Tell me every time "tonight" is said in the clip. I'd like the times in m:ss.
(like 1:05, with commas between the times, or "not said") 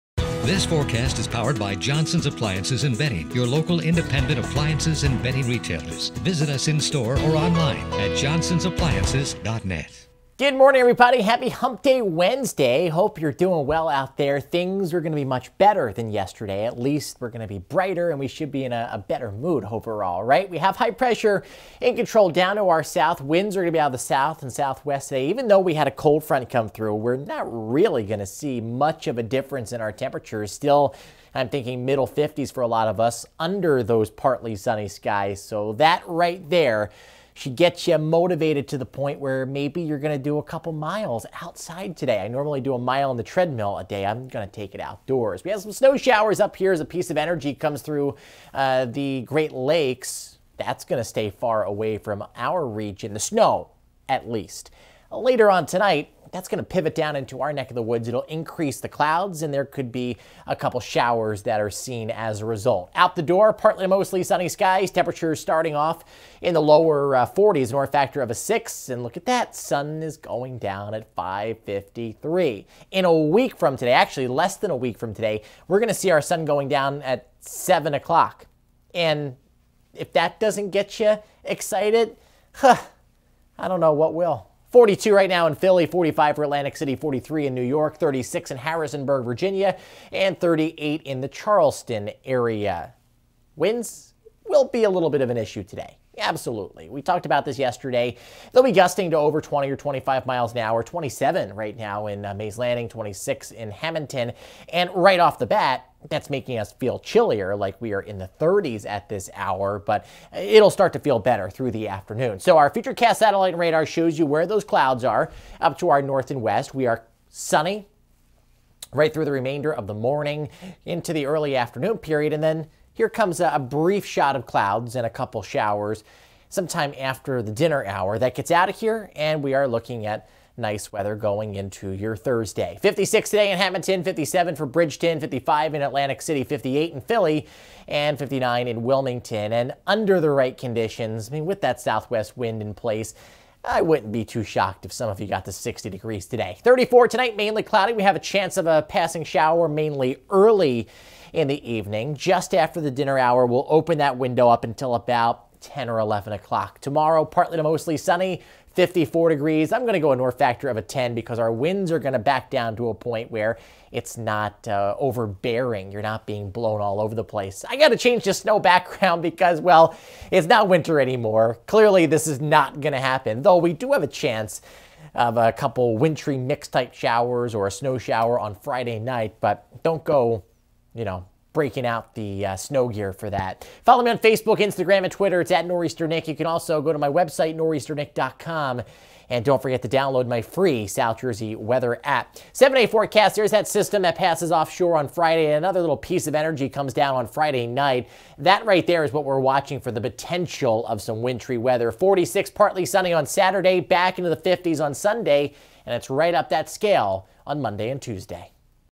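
0:55, 2:27.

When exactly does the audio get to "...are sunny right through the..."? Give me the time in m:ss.
1:56.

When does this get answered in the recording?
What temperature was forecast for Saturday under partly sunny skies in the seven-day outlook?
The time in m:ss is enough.
3:21.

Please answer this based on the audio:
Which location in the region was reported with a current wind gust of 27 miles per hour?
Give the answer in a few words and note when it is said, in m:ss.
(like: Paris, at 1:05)
Mays Landing, at 1:42.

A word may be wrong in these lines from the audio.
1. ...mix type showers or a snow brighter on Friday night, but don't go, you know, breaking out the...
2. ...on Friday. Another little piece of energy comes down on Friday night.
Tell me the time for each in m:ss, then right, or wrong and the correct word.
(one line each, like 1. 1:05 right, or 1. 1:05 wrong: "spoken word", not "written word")
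1. 2:56 wrong: "shower", not "brighter"
2. 3:14 right.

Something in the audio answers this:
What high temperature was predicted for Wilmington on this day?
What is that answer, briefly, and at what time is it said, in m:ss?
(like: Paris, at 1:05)
59, at 2:18.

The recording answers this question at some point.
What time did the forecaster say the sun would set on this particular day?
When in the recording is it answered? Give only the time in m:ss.
1:11.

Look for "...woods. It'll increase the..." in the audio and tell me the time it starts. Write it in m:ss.
0:57.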